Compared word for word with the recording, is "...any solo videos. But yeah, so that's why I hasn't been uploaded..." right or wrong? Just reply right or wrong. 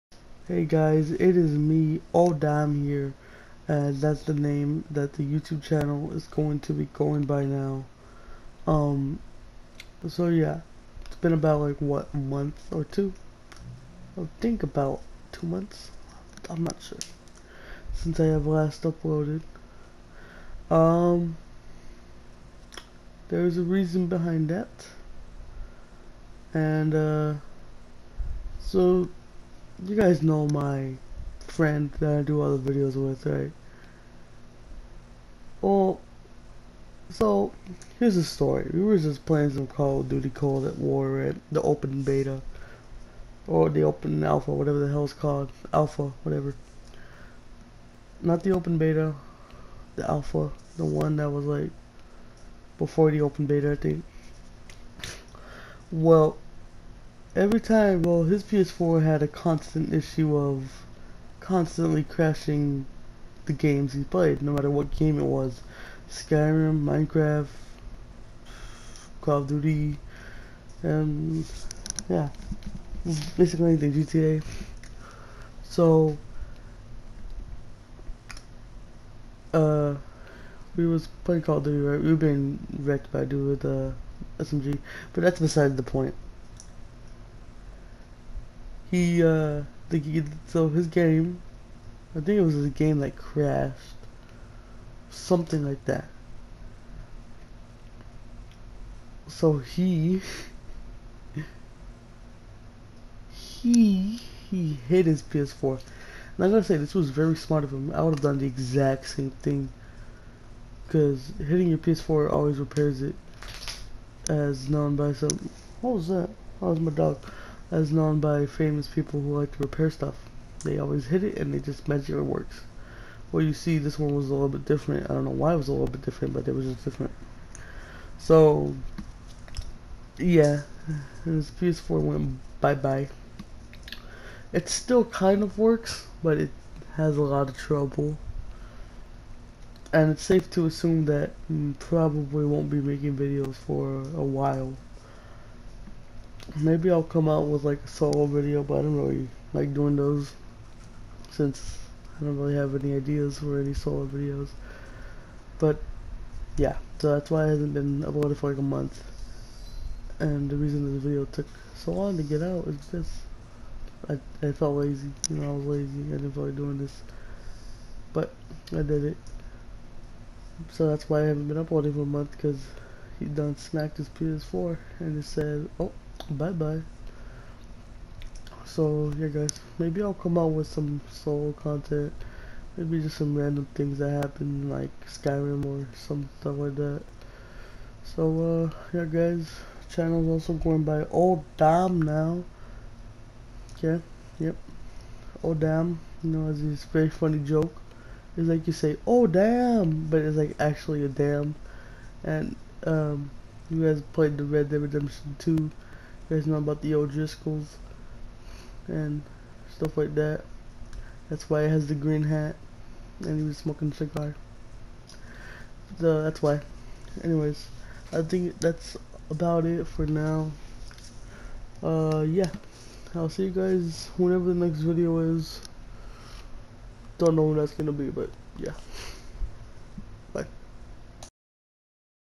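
right.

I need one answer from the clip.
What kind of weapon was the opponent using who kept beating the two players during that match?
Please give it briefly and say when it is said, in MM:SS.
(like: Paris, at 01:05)
SMG, at 01:24.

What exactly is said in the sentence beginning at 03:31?
That's why he has the green hat and he was smoking a cigar.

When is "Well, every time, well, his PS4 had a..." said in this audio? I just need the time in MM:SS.
00:55.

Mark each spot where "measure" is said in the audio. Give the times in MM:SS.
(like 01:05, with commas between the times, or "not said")
02:01.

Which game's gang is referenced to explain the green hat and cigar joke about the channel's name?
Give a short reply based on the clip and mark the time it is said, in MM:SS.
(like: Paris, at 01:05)
Red Dead Redemption 2, at 03:24.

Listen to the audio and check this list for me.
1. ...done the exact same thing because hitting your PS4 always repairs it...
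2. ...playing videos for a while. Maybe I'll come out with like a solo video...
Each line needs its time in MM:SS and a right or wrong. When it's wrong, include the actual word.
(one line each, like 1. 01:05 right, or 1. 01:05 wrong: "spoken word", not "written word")
1. 01:48 right
2. 02:22 wrong: "making", not "playing".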